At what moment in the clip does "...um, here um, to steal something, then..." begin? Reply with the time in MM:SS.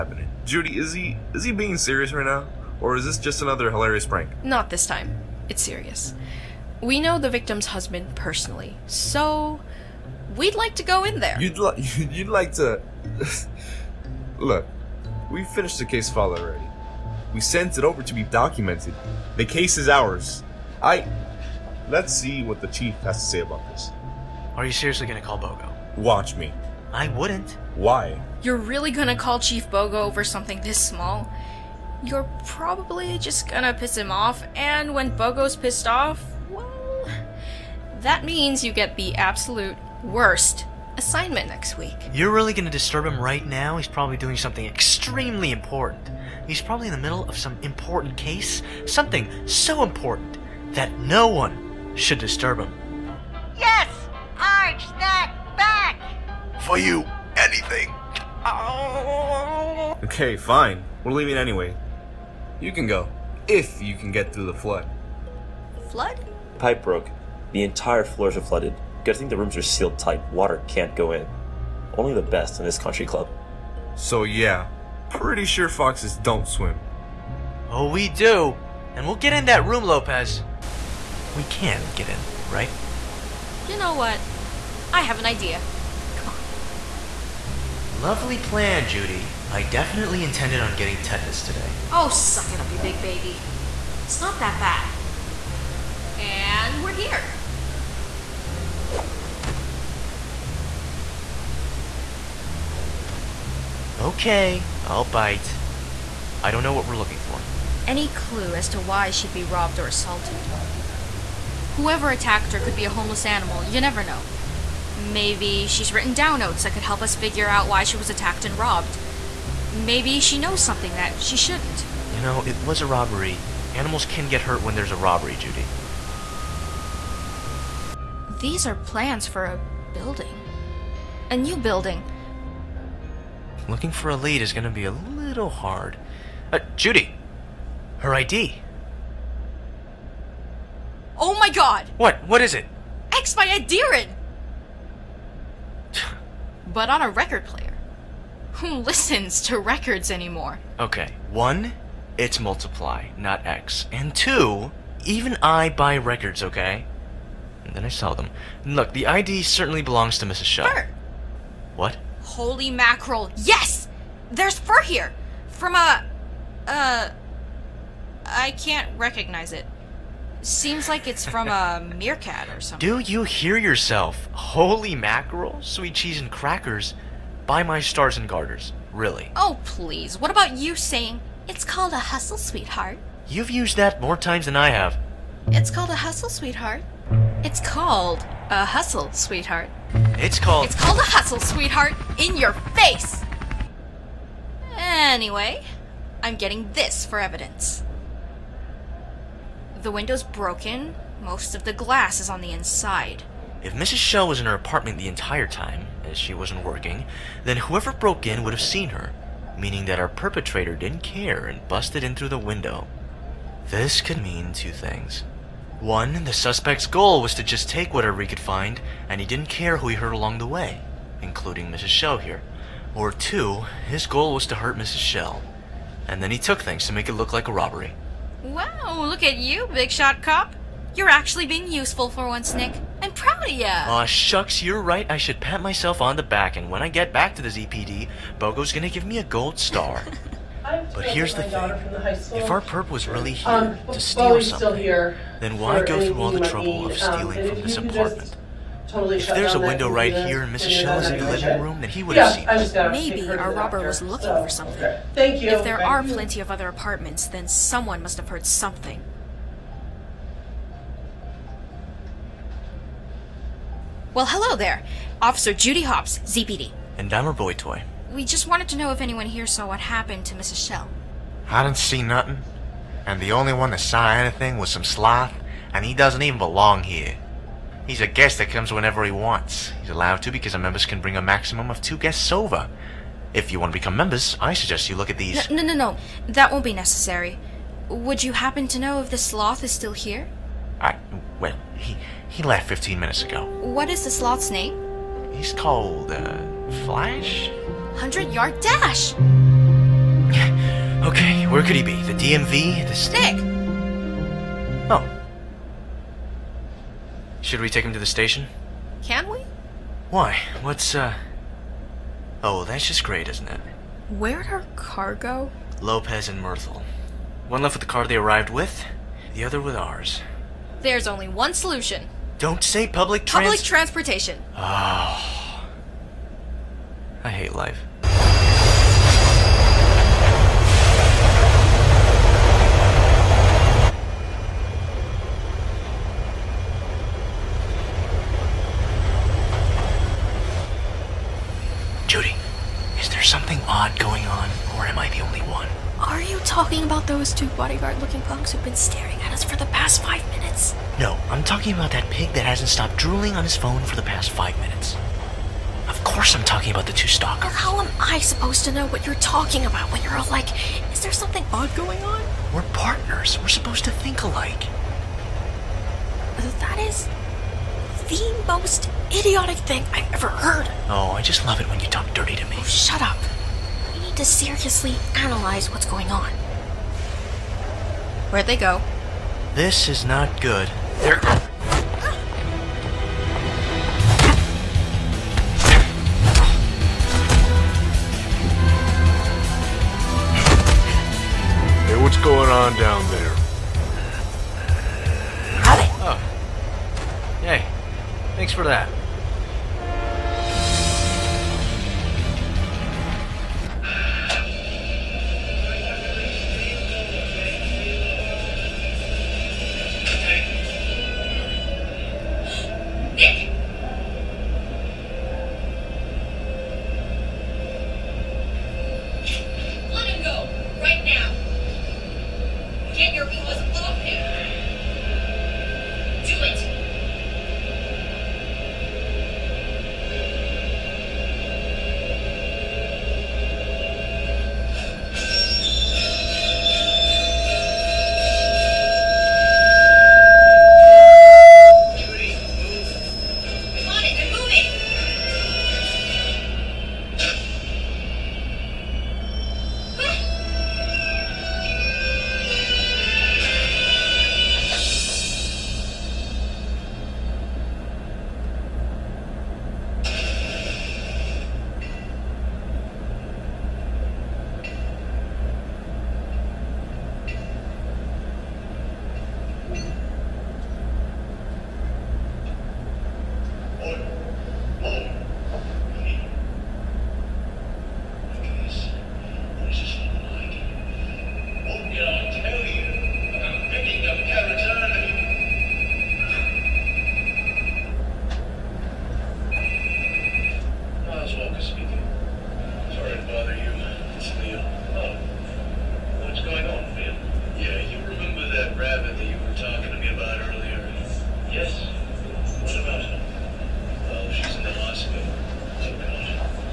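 04:03.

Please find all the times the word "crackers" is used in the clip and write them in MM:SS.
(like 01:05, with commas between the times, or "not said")
02:56.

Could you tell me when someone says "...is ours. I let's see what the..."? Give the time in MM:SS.
00:19.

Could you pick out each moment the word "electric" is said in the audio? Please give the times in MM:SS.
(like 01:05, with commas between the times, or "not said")
not said.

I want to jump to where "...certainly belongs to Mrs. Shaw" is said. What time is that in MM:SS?
02:39.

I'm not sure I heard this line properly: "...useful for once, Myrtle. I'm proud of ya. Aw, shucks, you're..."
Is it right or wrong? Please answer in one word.
wrong.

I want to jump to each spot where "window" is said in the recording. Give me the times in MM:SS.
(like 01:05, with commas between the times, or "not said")
03:19, 03:32, 04:09.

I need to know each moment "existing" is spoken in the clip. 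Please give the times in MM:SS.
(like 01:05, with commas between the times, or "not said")
not said.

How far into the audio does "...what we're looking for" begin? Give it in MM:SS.
01:46.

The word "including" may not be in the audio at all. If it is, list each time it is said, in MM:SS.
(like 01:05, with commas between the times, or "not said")
03:41.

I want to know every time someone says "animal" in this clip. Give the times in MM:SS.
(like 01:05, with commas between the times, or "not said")
01:53, 02:03.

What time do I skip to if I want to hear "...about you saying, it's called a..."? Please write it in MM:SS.
03:00.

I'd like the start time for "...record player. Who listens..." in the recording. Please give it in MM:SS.
02:27.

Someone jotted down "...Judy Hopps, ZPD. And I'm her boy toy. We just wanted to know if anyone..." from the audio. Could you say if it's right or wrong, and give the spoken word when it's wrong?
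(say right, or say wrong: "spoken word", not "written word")
right.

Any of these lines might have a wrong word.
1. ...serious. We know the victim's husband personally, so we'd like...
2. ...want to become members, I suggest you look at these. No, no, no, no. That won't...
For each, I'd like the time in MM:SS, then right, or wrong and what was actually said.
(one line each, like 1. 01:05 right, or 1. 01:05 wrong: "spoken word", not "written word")
1. 00:05 right
2. 04:43 right.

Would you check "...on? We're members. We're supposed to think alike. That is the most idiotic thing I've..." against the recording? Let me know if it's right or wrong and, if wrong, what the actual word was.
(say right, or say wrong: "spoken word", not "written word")
wrong: "partners", not "members".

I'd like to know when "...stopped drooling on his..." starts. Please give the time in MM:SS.
05:52.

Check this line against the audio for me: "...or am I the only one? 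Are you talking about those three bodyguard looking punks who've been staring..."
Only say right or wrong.
wrong.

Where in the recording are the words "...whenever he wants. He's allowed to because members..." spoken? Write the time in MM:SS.
04:38.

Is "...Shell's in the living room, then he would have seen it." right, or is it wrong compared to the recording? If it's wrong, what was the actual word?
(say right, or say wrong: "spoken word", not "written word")
right.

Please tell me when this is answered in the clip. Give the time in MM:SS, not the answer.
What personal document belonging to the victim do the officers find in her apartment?
02:17.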